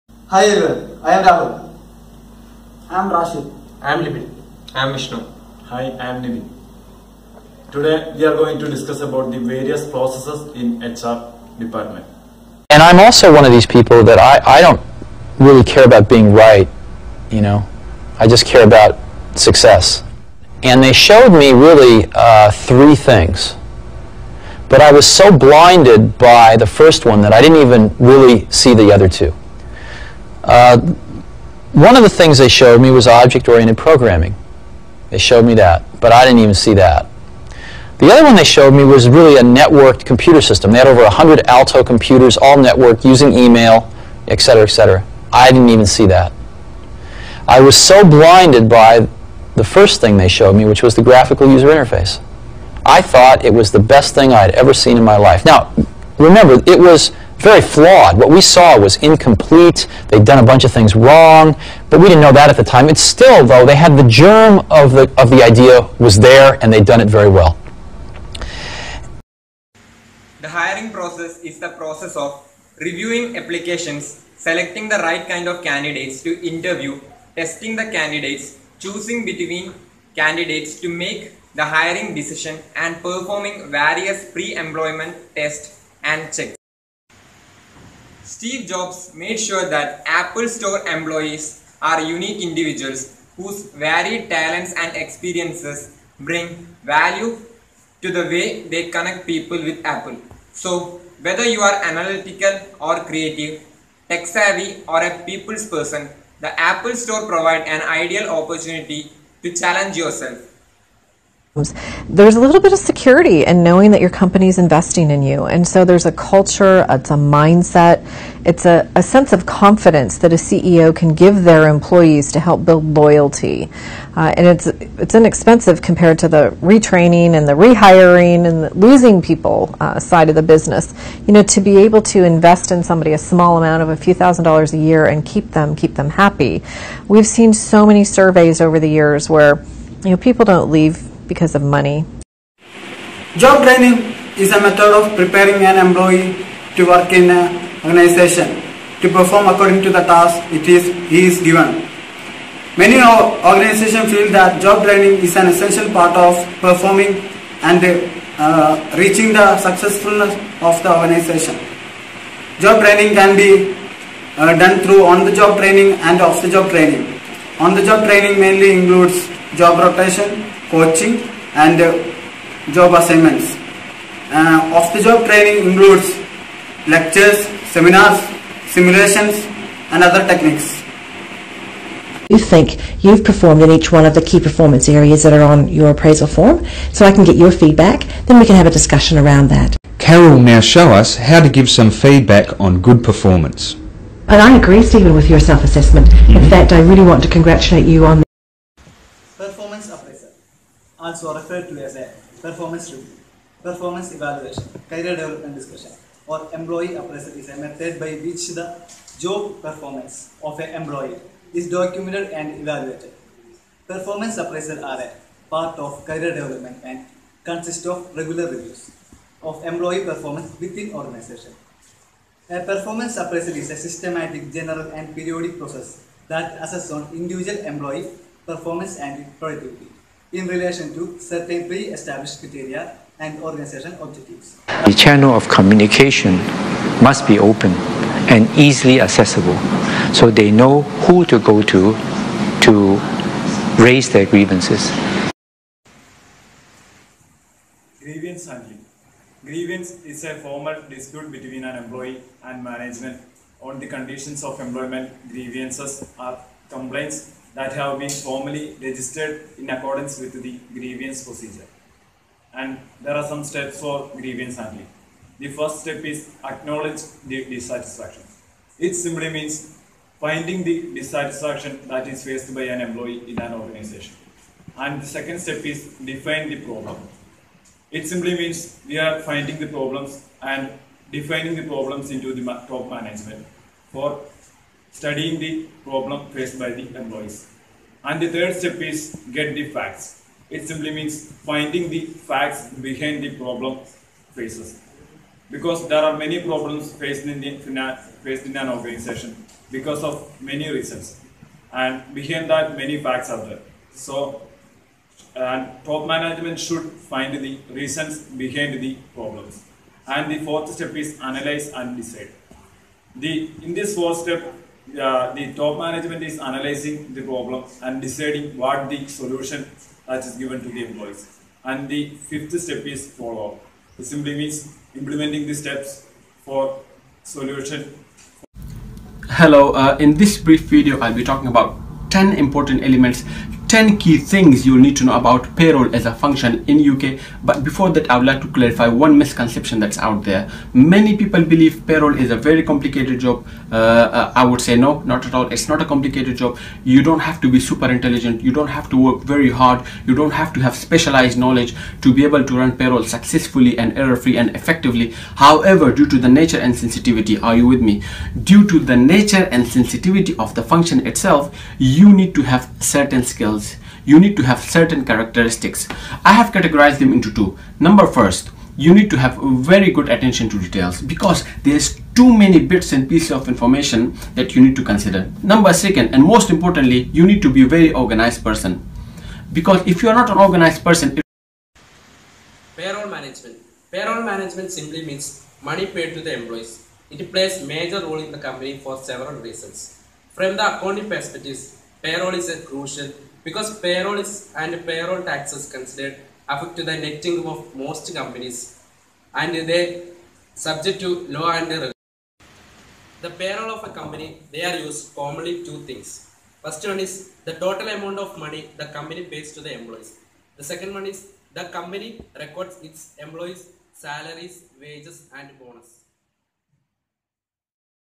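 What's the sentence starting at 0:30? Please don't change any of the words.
Uh, one of the things they showed me was object-oriented programming.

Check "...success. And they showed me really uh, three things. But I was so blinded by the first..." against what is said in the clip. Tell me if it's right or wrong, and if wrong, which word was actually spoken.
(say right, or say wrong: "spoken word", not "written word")
right.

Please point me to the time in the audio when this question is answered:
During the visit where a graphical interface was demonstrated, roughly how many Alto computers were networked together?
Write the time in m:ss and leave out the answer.
0:40.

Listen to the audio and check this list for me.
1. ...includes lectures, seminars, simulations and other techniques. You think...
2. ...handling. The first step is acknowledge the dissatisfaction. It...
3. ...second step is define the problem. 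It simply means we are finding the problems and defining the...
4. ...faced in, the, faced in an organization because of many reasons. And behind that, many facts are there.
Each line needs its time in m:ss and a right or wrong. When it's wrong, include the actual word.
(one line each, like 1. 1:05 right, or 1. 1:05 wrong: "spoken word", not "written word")
1. 2:55 right
2. 4:24 right
3. 4:35 right
4. 4:56 right.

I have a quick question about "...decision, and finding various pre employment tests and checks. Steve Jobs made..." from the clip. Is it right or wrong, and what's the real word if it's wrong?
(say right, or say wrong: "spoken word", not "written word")
wrong: "performing", not "finding".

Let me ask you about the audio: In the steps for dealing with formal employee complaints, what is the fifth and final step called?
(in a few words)
follow up.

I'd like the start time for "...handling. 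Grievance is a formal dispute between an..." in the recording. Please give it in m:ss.
4:08.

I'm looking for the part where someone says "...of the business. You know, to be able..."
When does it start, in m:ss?
2:10.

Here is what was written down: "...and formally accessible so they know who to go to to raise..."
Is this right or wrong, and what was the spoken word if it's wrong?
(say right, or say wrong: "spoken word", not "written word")
wrong: "easily", not "formally".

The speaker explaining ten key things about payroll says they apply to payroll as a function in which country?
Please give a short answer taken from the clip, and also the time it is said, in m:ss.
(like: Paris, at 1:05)
UK, at 5:36.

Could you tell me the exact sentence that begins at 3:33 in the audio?
Performance appraisal are a part of career development and consist of regular reviews of employee performance within organization.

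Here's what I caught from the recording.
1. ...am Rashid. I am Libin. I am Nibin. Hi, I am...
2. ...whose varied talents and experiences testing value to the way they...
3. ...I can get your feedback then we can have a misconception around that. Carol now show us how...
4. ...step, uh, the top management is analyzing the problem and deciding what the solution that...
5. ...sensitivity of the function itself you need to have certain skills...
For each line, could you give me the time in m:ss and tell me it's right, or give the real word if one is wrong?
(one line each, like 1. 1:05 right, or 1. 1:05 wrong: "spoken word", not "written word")
1. 0:03 wrong: "Vishnu", not "Nibin"
2. 1:33 wrong: "bring", not "testing"
3. 3:07 wrong: "discussion", not "misconception"
4. 5:14 right
5. 5:59 right.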